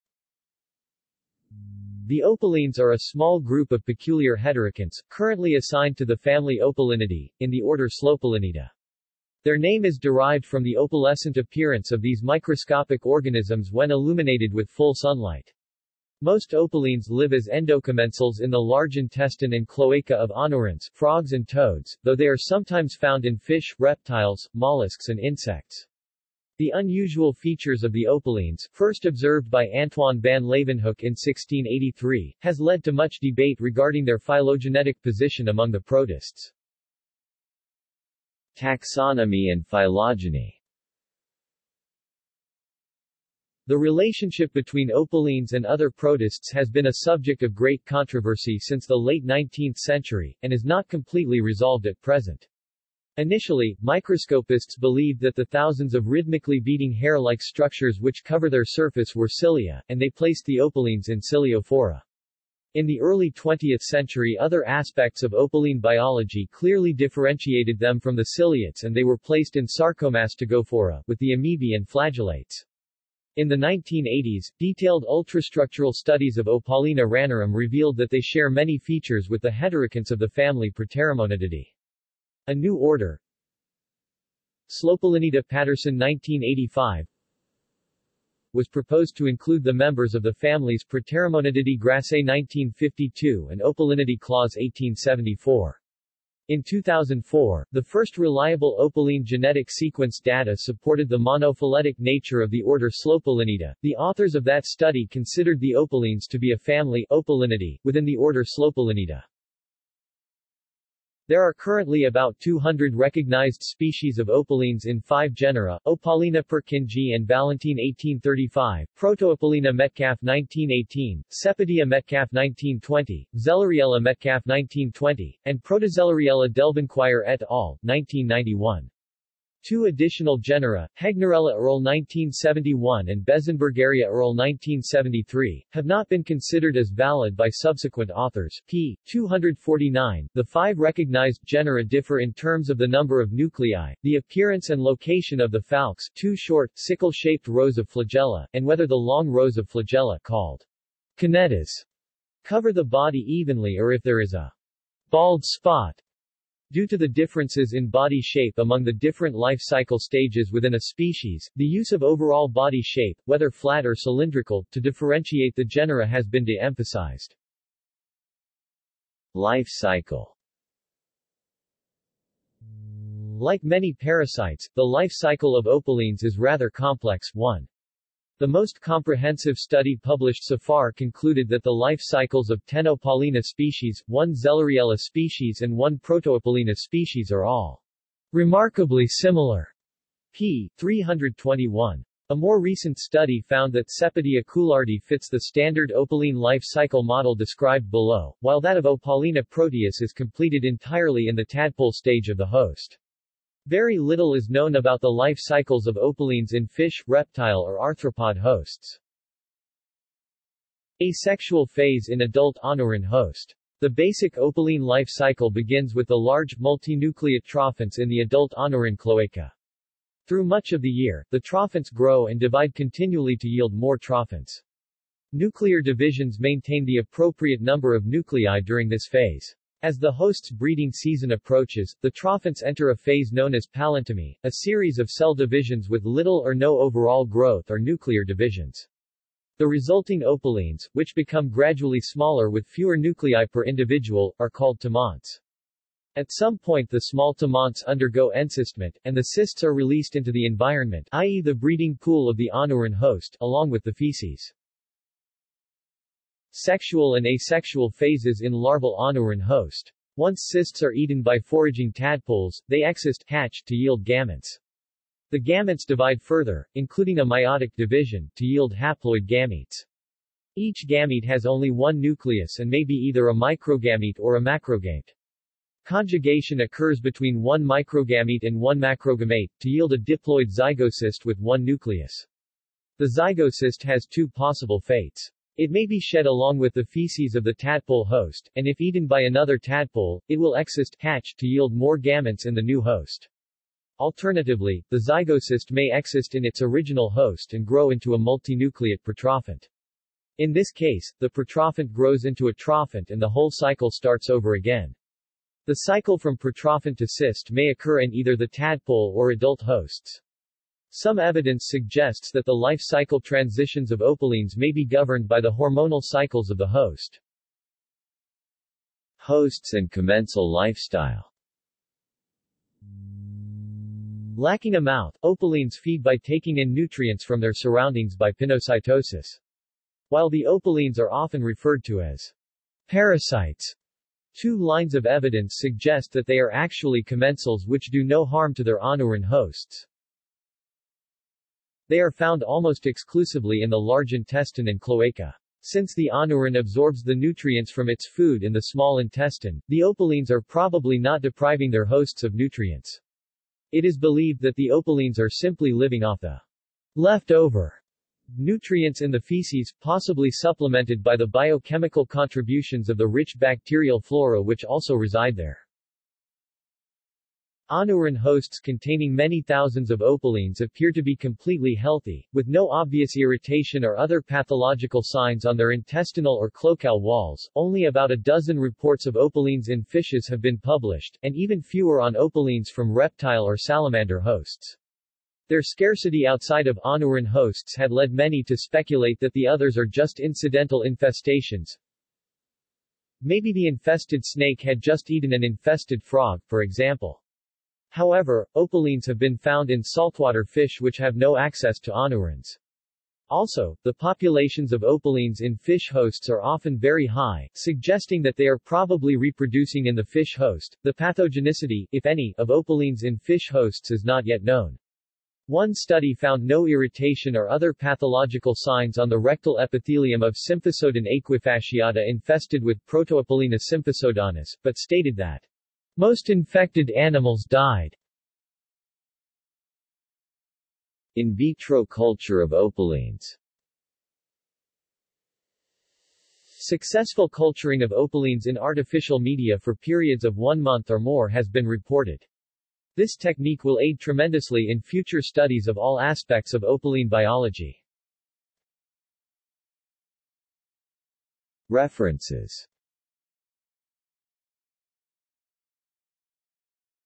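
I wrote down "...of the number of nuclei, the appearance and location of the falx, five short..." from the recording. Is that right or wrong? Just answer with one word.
wrong.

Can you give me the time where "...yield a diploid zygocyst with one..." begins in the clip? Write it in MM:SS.
04:39.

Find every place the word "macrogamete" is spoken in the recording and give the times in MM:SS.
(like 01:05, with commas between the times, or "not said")
04:34, 04:38.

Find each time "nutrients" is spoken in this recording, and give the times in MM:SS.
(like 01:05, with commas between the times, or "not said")
05:26, 05:47, 05:52, 05:58.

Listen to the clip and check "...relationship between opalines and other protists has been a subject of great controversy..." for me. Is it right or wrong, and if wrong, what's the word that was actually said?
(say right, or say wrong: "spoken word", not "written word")
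right.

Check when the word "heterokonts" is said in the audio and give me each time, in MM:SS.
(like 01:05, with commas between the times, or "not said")
00:04, 01:19.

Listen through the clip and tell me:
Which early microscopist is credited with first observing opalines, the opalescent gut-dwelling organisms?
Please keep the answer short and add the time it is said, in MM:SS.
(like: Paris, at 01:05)
Antoine van Leeuwenhoek, at 00:29.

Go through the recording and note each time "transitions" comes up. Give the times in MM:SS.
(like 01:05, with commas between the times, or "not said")
05:13.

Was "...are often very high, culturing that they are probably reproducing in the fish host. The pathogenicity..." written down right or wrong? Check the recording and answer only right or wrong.
wrong.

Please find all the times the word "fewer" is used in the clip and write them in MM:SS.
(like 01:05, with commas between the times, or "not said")
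04:02, 06:21.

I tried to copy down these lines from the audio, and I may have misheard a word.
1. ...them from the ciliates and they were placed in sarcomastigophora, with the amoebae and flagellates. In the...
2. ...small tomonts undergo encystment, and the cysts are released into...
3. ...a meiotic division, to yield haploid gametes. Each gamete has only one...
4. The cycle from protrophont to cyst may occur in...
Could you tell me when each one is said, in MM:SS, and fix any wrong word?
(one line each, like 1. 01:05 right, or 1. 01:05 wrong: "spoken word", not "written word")
1. 01:07 right
2. 04:07 right
3. 04:27 right
4. 05:05 right.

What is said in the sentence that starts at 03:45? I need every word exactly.
Nuclear divisions maintain the appropriate number of nuclei during this phase.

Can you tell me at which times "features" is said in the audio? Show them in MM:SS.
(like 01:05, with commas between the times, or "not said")
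00:27, 01:18.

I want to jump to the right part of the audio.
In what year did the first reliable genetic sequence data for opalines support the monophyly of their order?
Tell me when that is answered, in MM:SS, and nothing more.
01:36.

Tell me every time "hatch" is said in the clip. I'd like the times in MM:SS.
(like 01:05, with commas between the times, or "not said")
04:23, 04:50.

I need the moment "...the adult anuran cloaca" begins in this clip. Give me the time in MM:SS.
03:38.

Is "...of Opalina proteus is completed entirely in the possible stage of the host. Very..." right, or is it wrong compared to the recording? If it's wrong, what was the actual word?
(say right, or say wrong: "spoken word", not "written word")
wrong: "tadpole", not "possible".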